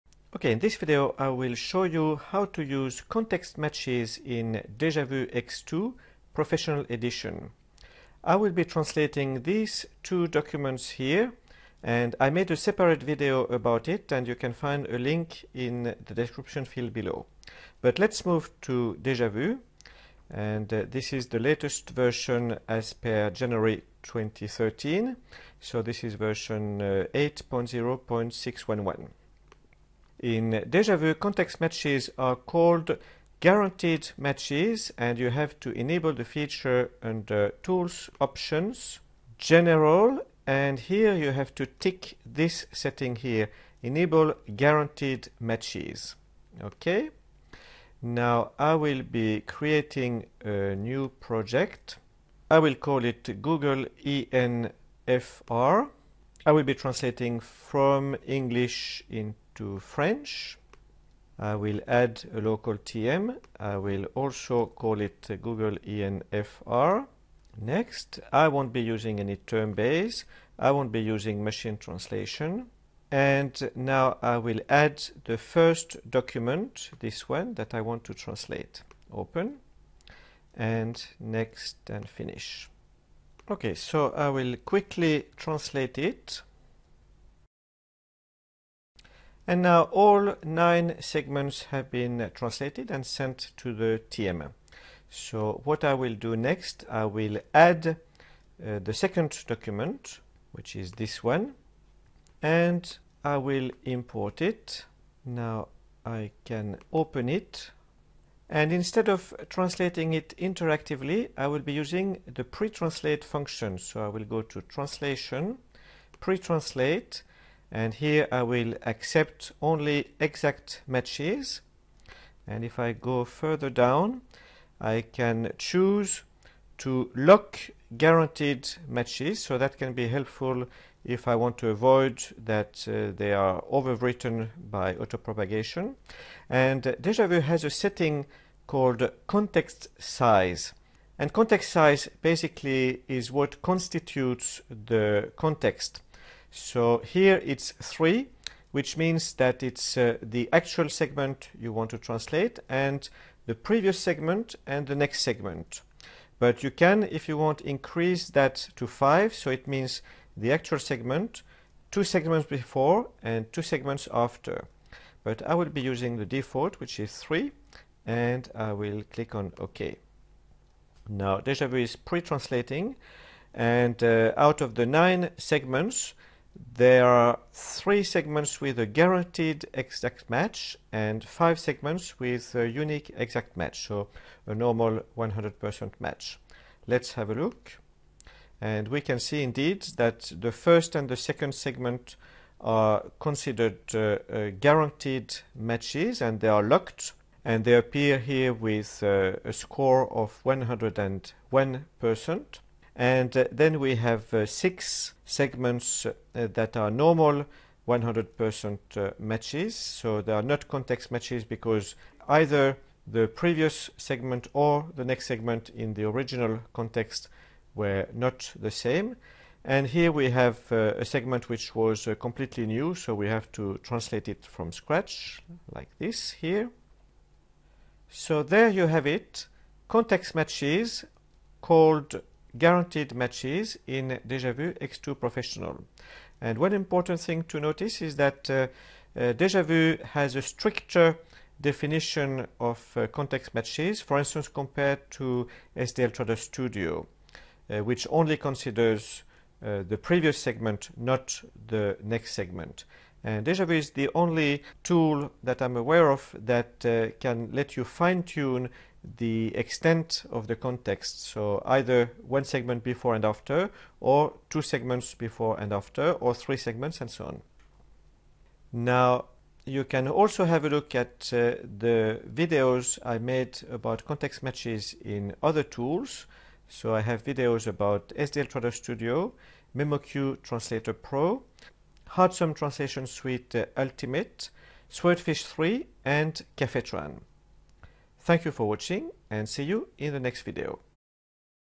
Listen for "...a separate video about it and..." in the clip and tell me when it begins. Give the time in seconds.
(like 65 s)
12 s.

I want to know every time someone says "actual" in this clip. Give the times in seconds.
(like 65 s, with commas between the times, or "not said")
150 s, 160 s.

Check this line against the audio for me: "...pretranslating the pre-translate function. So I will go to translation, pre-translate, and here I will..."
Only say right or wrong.
wrong.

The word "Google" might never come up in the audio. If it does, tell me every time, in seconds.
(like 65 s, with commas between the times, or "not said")
53 s, 65 s.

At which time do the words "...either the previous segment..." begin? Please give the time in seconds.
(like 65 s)
212 s.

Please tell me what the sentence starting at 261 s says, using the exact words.
So either one segment before and after, or two segments before and after, or three segments, and so on.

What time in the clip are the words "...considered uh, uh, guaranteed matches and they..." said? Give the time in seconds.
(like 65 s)
193 s.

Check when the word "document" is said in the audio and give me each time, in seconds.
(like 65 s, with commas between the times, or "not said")
10 s, 76 s, 99 s.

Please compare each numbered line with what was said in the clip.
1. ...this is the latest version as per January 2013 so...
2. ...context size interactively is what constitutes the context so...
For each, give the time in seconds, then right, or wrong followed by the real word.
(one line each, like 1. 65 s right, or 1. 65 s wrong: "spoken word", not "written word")
1. 20 s right
2. 141 s wrong: "basically", not "interactively".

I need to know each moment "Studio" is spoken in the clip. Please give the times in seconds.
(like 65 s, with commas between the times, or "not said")
246 s, 278 s.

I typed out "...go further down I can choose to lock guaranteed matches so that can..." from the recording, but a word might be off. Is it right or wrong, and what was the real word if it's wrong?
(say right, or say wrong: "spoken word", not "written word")
right.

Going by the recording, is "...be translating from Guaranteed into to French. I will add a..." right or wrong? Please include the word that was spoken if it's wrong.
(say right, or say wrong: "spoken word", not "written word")
wrong: "English", not "Guaranteed".